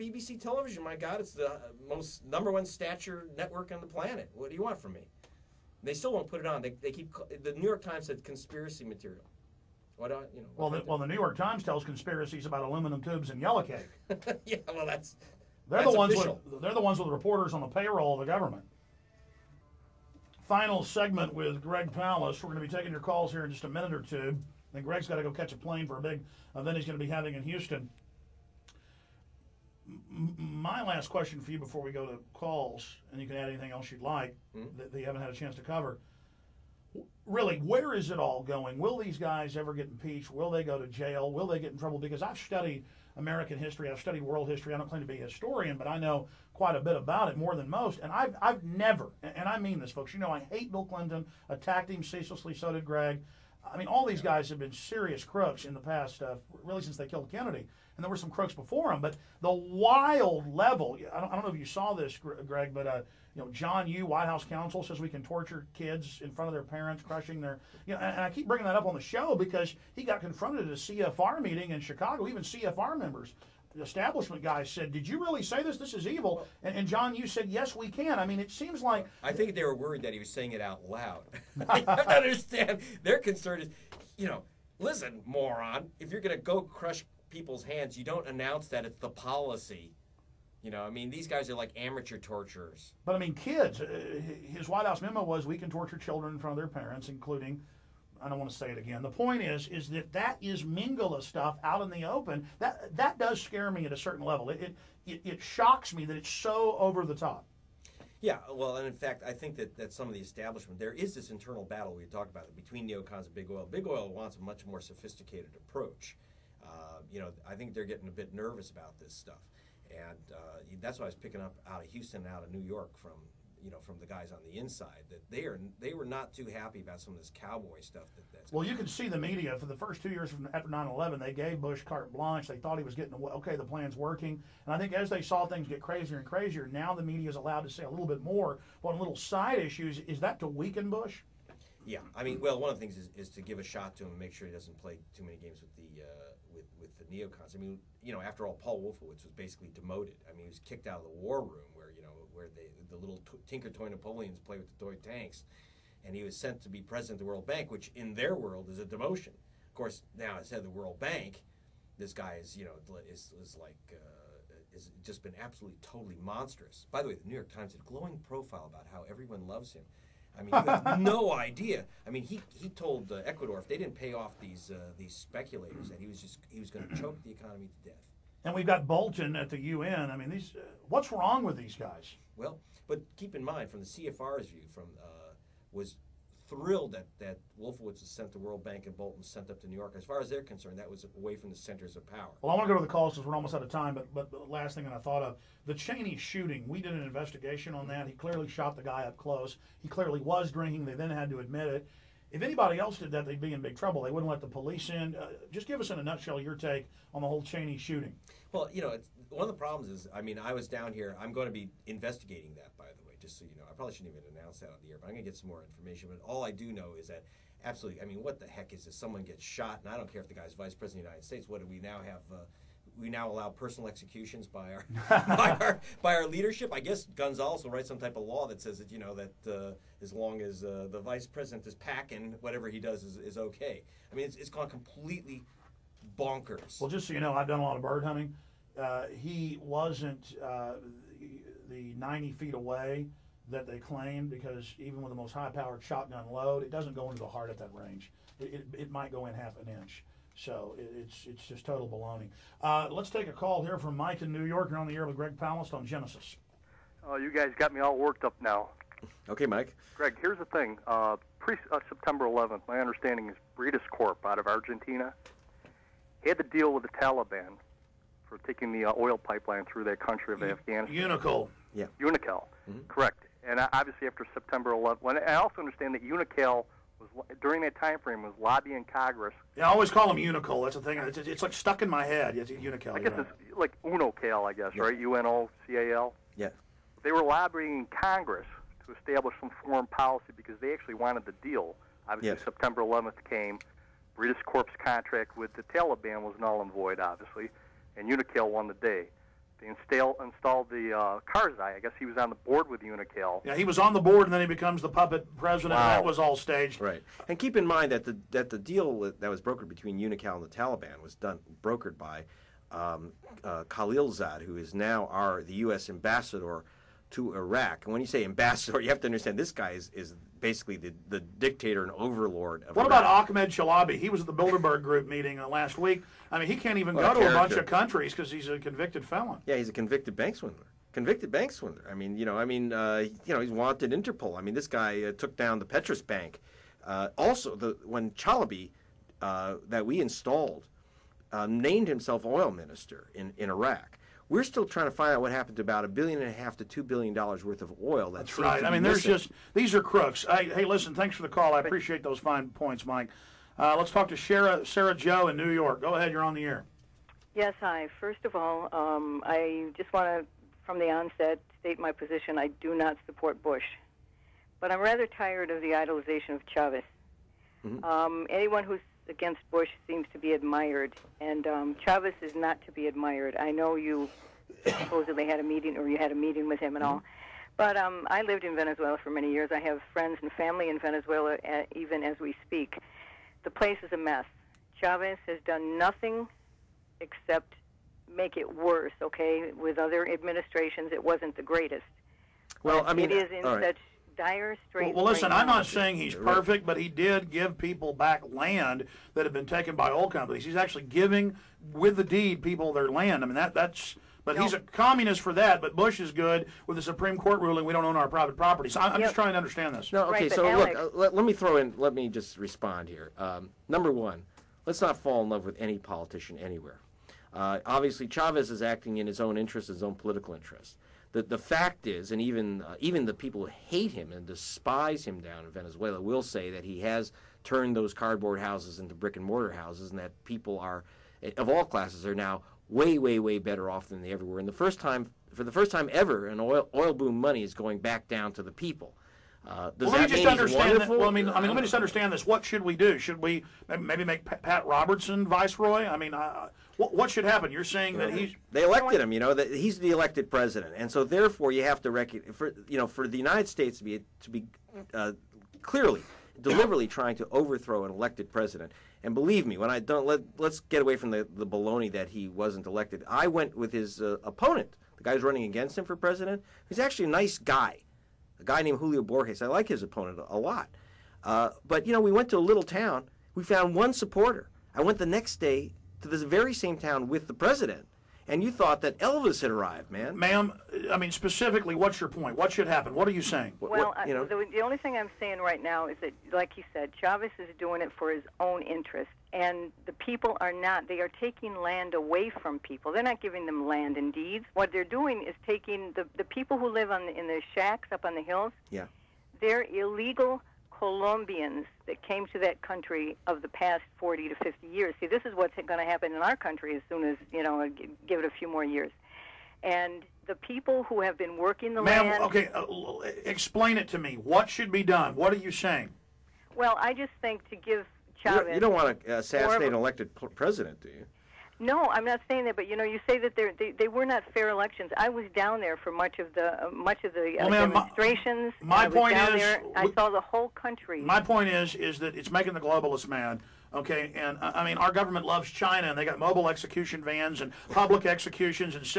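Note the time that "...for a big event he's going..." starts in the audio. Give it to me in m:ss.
0:25.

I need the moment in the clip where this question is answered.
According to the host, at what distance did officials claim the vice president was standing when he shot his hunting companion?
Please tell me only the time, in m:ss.
4:01.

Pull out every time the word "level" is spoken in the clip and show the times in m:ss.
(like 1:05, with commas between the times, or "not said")
1:00, 1:44.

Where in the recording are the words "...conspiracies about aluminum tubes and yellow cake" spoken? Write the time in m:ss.
0:11.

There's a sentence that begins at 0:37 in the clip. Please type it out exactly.
Really, where is it all going?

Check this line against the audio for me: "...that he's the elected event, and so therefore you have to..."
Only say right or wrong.
wrong.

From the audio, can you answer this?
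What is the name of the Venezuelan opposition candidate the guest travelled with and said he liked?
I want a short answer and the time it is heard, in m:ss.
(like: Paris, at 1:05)
Julio Borges, at 7:48.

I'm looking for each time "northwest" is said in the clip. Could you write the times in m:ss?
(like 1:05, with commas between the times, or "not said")
not said.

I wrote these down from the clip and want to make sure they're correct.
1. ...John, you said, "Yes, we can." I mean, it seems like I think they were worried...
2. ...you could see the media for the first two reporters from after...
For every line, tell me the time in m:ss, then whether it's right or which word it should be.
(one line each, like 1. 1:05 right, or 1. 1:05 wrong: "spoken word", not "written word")
1. 1:16 right
2. 2:08 wrong: "years", not "reporters".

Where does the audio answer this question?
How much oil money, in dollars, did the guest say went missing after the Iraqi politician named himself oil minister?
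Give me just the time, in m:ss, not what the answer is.
5:45.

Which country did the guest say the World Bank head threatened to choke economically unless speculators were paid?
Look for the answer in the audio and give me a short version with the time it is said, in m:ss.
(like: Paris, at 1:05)
Ecuador, at 2:53.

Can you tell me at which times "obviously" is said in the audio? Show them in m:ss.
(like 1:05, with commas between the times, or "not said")
4:33, 4:52, 4:56, 6:57.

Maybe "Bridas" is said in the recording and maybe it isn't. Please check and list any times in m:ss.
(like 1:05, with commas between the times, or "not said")
4:23, 4:54.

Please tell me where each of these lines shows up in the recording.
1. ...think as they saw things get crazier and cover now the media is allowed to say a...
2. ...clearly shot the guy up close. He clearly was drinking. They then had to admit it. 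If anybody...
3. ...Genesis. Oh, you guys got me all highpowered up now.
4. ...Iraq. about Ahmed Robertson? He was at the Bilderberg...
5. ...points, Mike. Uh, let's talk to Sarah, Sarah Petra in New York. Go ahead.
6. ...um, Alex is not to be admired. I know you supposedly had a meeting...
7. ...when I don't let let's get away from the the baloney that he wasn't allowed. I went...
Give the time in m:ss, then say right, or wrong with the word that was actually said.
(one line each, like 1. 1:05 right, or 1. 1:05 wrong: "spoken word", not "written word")
1. 2:14 wrong: "crazier", not "cover"
2. 3:18 right
3. 4:15 wrong: "worked", not "highpowered"
4. 5:22 wrong: "Chalabi", not "Robertson"
5. 5:52 wrong: "Joe", not "Petra"
6. 6:11 wrong: "Chavez", not "Alex"
7. 7:39 wrong: "elected", not "allowed".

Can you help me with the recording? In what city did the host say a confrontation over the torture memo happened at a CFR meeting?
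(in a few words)
Chicago.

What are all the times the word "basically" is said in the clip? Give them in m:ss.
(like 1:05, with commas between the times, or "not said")
2:29, 5:20.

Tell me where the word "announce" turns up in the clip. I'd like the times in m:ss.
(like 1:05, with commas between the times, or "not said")
1:28, 3:34.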